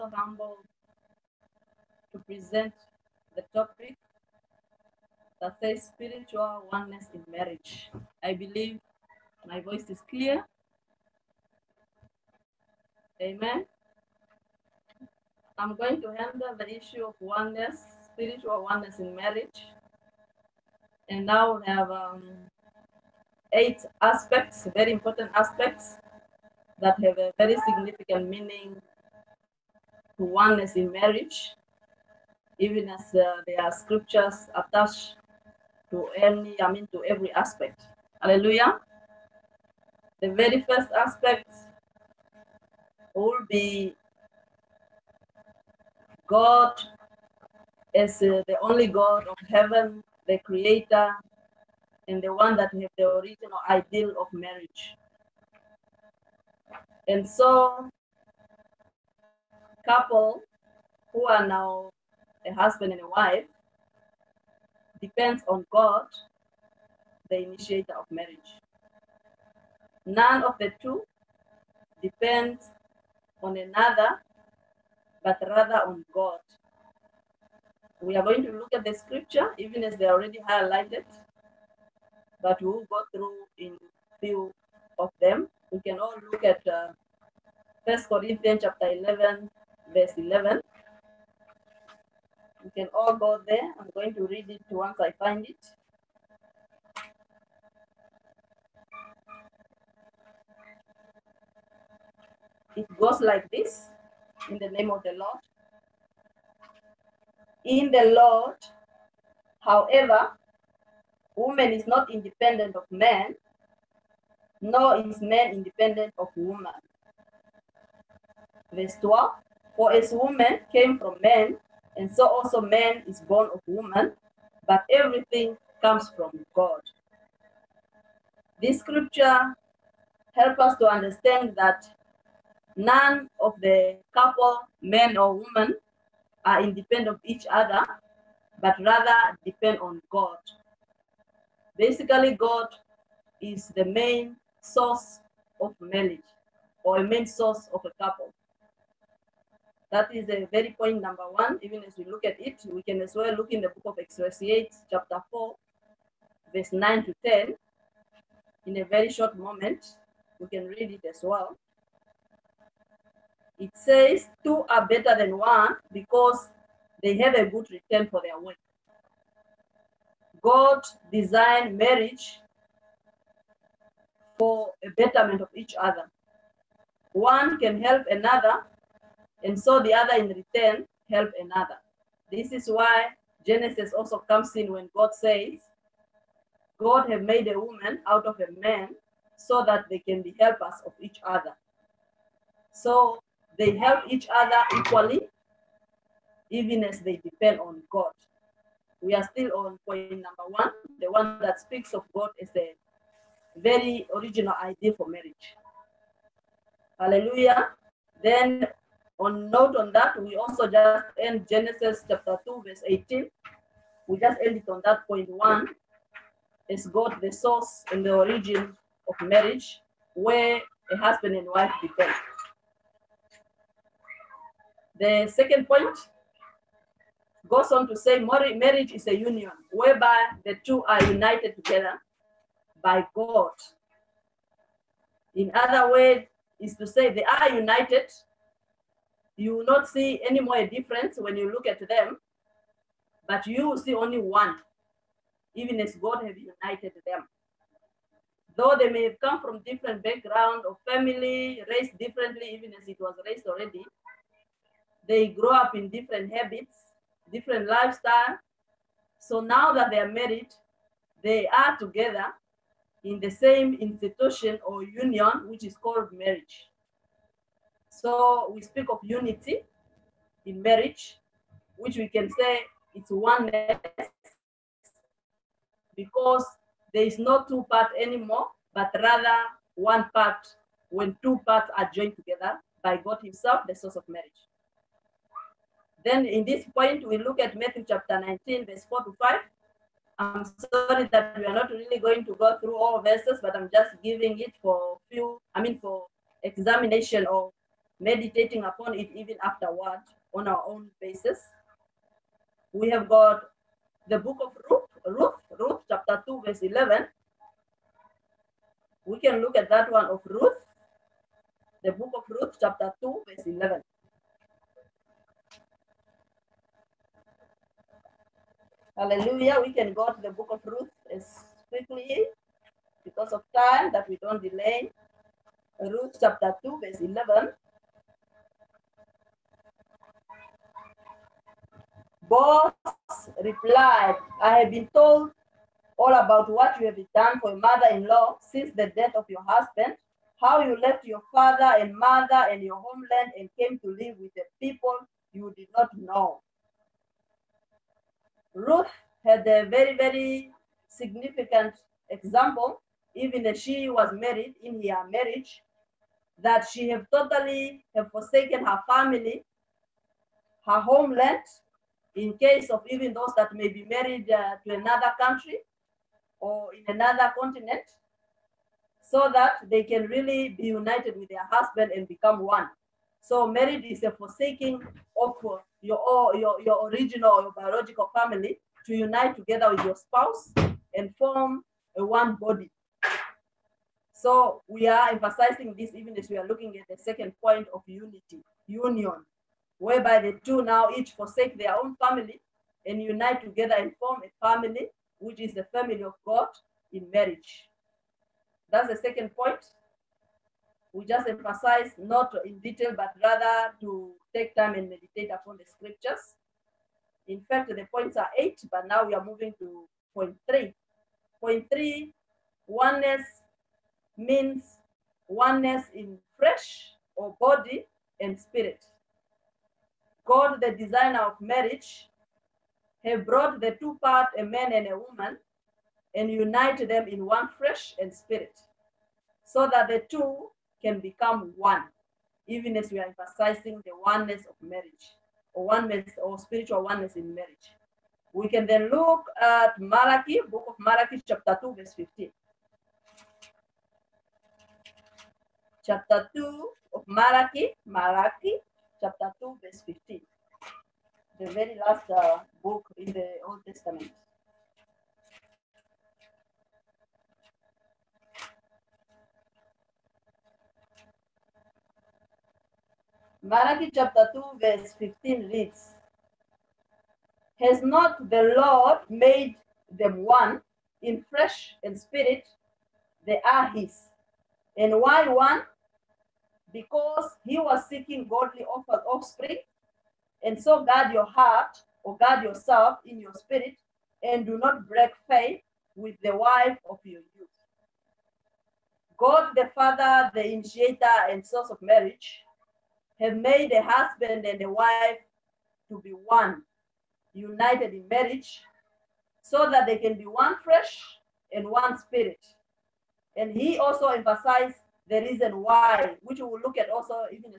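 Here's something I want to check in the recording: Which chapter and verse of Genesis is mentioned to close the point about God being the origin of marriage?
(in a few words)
Genesis 2:18.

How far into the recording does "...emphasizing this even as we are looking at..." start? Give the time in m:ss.
6:25.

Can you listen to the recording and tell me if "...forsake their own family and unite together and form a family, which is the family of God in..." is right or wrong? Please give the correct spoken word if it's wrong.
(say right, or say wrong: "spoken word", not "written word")
right.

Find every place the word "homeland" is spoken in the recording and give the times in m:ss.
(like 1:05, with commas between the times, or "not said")
5:42, 6:00.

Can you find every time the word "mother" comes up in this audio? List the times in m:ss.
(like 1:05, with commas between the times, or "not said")
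5:37, 5:41.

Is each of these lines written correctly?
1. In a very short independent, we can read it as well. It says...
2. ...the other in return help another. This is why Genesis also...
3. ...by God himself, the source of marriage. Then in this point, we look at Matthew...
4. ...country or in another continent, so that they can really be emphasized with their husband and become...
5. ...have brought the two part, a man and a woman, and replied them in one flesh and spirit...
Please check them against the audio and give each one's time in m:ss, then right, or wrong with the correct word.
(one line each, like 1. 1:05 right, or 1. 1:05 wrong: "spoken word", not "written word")
1. 2:38 wrong: "moment", not "independent"
2. 2:59 right
3. 4:42 right
4. 6:05 wrong: "united", not "emphasized"
5. 7:03 wrong: "united", not "replied".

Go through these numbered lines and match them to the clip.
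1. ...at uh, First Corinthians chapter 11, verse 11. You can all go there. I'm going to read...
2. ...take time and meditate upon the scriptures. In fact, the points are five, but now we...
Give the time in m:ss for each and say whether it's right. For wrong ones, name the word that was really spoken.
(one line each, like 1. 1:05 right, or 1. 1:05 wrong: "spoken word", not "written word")
1. 1:26 right
2. 6:44 wrong: "eight", not "five".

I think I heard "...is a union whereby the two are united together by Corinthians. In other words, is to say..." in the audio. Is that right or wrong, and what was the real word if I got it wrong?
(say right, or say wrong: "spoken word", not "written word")
wrong: "God", not "Corinthians".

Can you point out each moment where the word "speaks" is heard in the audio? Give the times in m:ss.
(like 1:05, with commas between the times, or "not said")
3:21, 4:28.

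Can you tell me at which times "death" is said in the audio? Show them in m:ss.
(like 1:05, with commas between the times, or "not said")
5:38.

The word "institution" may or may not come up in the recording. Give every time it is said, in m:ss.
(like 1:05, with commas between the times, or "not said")
4:23.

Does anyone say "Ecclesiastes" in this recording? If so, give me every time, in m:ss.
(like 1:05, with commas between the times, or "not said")
2:33.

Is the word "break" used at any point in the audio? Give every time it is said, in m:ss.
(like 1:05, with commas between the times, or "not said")
8:04.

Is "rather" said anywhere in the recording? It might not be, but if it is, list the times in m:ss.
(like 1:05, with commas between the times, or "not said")
1:15, 2:18, 4:38, 6:43.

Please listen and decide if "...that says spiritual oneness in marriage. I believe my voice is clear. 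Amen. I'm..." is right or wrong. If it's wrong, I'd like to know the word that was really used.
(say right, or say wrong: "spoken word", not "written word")
right.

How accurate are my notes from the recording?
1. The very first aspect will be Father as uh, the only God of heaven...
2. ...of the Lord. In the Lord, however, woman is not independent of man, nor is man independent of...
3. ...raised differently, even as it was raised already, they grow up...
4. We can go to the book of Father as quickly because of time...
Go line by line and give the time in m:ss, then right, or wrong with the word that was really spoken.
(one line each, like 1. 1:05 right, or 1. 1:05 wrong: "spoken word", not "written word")
1. 0:40 wrong: "God", not "Father"
2. 1:44 right
3. 4:11 right
4. 5:19 wrong: "Ruth", not "Father".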